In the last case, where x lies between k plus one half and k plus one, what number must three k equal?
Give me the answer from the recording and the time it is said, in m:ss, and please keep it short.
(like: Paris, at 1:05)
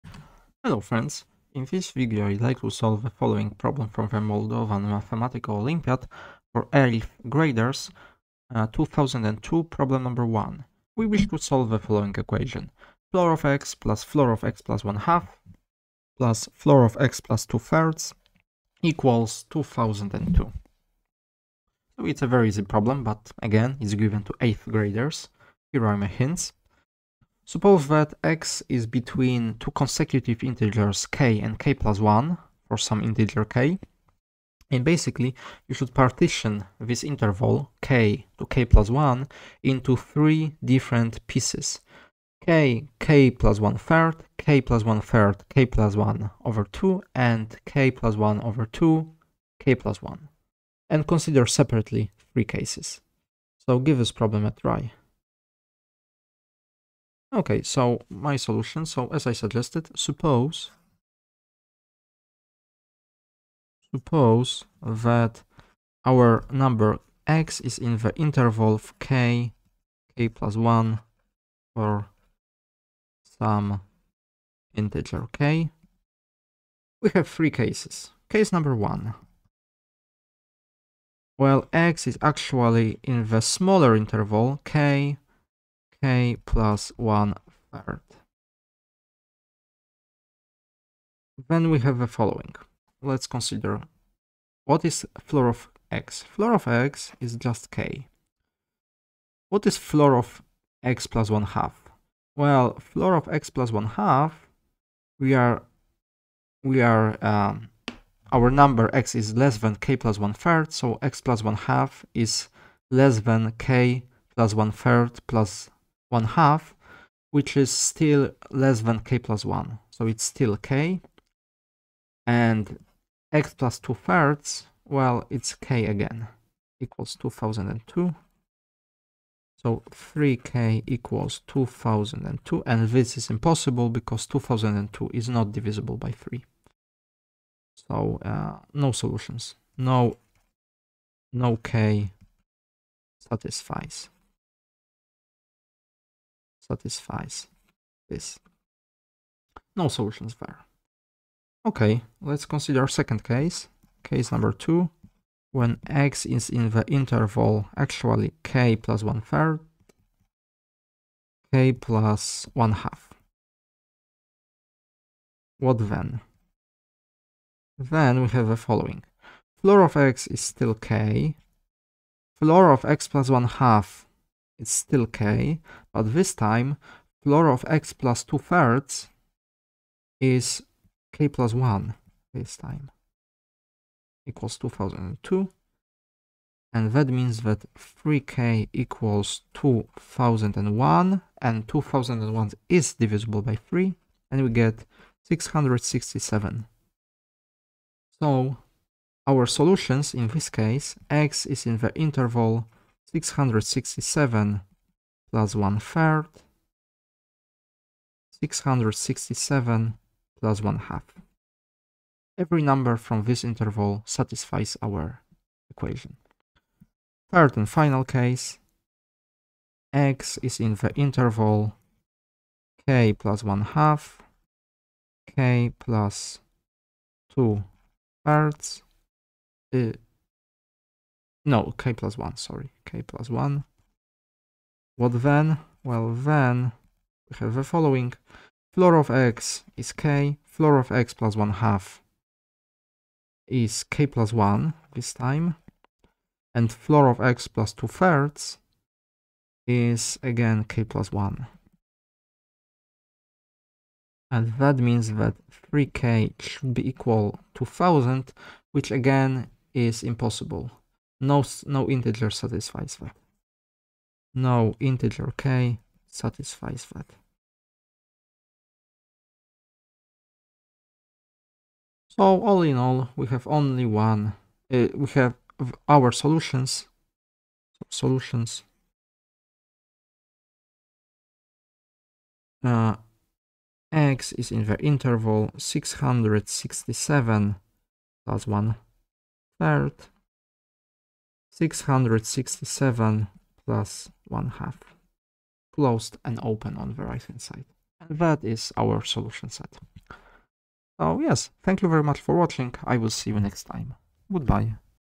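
1000, at 4:17.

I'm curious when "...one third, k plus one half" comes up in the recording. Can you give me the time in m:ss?
2:39.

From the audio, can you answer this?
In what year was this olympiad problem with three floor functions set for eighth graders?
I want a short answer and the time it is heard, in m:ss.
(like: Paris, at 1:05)
2002, at 0:08.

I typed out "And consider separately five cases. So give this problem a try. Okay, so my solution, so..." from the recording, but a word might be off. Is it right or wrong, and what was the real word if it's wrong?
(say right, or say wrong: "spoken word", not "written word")
wrong: "three", not "five".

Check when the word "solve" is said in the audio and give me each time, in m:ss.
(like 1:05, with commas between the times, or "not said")
0:02, 0:11.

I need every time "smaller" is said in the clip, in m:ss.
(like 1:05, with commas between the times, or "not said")
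1:23.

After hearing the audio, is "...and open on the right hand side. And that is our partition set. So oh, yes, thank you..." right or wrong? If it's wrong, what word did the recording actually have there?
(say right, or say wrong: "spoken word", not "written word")
wrong: "solution", not "partition".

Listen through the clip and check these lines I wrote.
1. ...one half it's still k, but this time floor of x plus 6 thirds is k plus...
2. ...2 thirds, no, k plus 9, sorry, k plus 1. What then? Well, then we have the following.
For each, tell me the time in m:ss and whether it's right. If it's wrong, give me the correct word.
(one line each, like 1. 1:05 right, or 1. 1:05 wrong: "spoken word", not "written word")
1. 2:53 wrong: "2", not "6"
2. 3:47 wrong: "1", not "9".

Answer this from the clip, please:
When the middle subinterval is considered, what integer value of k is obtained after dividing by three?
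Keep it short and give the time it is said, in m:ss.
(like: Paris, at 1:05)
667, at 3:14.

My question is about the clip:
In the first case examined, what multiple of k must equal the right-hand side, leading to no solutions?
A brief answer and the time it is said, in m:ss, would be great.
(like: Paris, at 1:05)
3k, at 2:09.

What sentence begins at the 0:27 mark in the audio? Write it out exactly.
Suppose that x is between two consecutive integers k and k plus 1 for some integer k.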